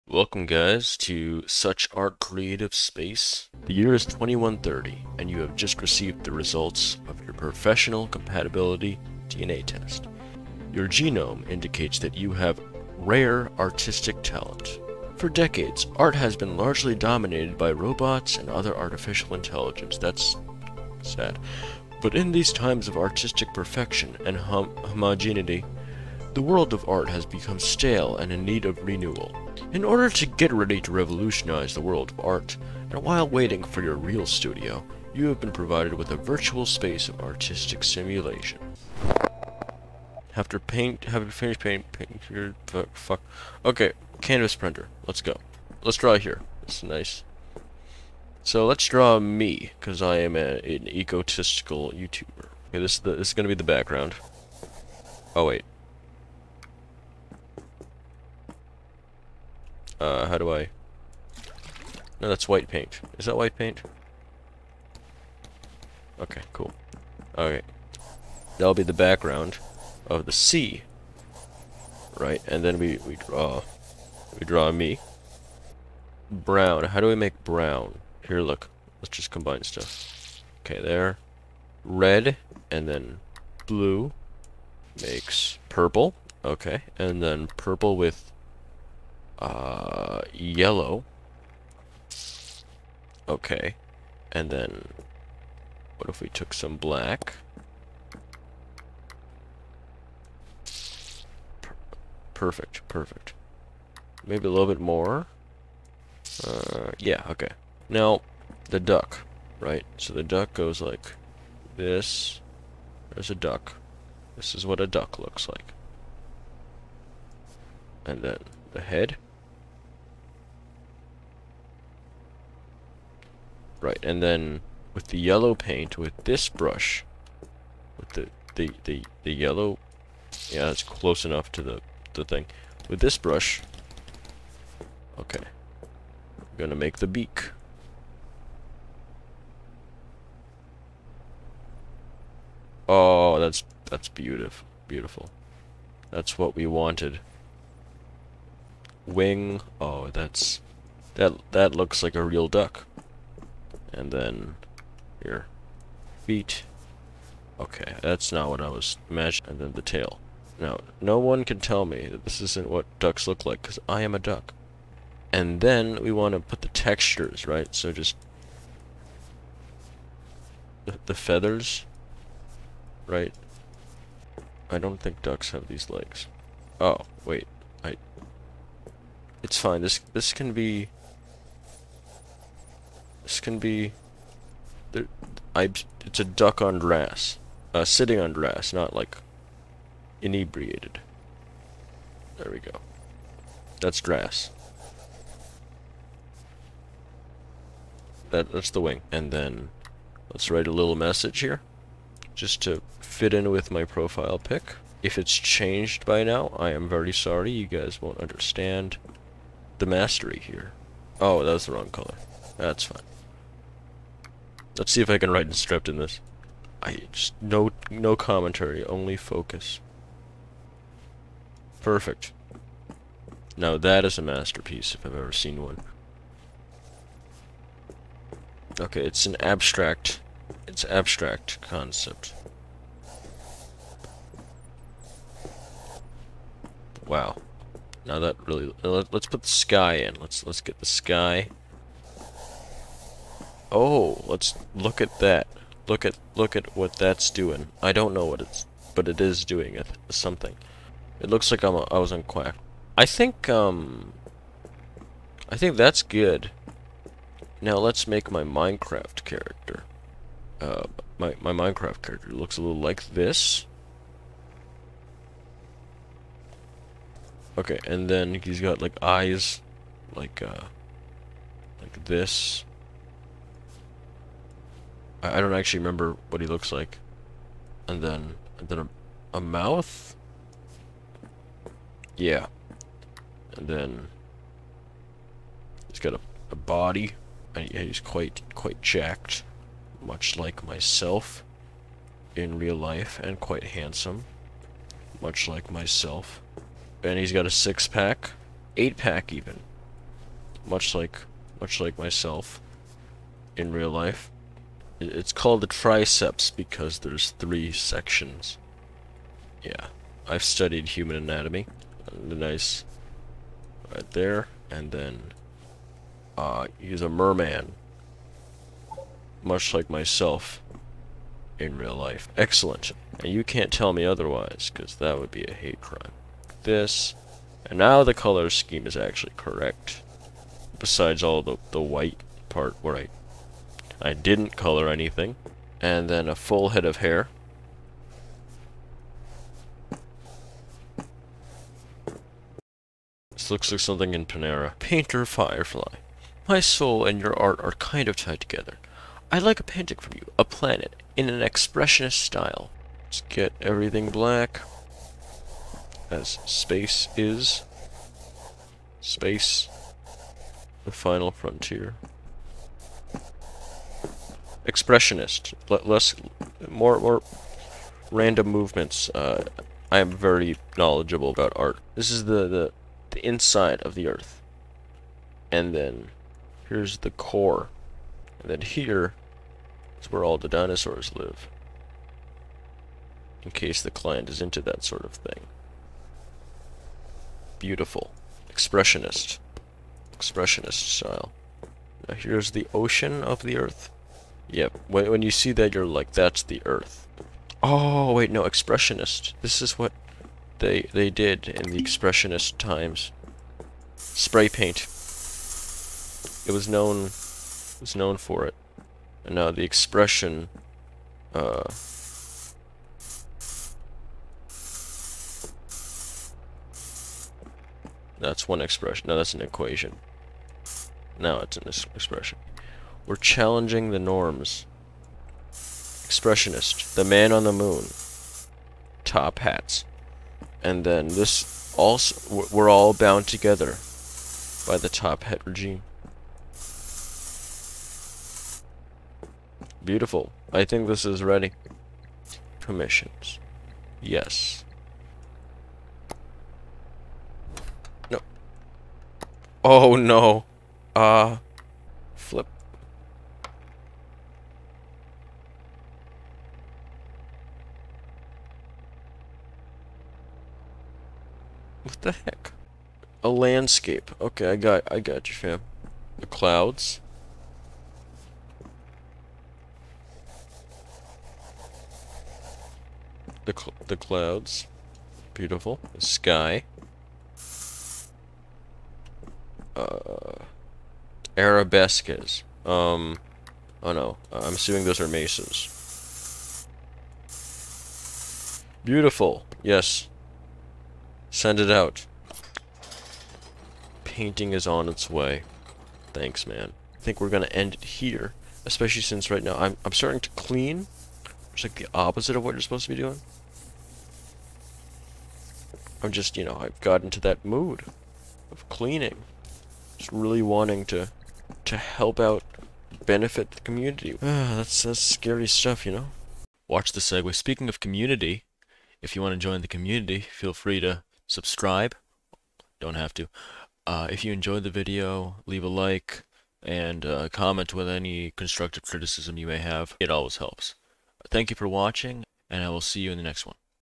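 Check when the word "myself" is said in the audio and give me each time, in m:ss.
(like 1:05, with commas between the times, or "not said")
4:50, 4:55, 5:01, 5:19.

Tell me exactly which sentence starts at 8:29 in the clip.
Just really wanting to to help out, benefit the community.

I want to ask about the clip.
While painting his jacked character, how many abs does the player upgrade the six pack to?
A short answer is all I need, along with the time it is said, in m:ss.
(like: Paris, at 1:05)
8, at 4:58.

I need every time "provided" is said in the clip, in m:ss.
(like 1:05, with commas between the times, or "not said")
0:35.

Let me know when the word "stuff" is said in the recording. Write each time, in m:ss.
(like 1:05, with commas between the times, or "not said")
1:19, 8:35.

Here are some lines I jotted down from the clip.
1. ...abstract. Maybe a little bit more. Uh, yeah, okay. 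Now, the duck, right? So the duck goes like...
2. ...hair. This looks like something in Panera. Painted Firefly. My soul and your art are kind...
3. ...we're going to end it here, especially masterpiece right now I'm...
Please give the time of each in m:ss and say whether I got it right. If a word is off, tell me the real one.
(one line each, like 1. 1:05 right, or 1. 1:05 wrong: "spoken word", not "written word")
1. 1:42 wrong: "perfect", not "abstract"
2. 5:36 right
3. 8:17 wrong: "since", not "masterpiece".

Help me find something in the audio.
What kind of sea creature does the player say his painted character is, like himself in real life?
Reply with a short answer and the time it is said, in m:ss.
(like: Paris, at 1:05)
A merman, at 5:17.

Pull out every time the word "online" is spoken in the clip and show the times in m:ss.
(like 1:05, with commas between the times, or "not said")
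not said.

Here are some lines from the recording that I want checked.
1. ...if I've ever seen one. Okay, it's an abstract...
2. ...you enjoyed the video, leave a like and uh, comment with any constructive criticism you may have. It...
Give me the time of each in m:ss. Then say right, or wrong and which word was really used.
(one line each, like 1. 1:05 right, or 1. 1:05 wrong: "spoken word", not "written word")
1. 3:44 right
2. 8:44 right.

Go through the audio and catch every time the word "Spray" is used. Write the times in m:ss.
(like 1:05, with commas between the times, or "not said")
6:43.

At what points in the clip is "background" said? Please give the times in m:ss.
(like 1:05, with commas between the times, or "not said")
0:53, 1:08.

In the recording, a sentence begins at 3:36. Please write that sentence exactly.
I just no no commentary, only focus.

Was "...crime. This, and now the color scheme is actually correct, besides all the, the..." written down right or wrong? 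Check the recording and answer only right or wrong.
right.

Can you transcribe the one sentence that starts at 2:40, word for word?
Now, no one can tell me that this isn't what ducks look like, because I am a duck.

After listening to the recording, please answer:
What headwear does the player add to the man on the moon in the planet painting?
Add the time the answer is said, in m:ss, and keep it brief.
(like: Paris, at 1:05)
Top hats, at 7:09.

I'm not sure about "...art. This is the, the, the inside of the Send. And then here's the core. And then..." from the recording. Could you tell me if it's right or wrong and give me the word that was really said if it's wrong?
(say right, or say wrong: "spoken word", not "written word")
wrong: "Earth", not "Send".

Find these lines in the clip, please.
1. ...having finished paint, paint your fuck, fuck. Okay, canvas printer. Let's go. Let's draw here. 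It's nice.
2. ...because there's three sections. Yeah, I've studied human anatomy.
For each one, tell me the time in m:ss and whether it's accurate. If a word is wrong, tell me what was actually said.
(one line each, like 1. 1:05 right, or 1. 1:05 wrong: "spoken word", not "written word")
1. 0:41 right
2. 5:06 right.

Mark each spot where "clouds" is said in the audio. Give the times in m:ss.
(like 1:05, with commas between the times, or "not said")
7:46, 7:53.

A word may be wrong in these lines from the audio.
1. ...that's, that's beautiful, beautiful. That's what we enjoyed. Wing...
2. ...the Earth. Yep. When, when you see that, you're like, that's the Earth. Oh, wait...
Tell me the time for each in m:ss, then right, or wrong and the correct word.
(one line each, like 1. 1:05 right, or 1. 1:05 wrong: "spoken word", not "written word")
1. 2:23 wrong: "wanted", not "enjoyed"
2. 6:33 right.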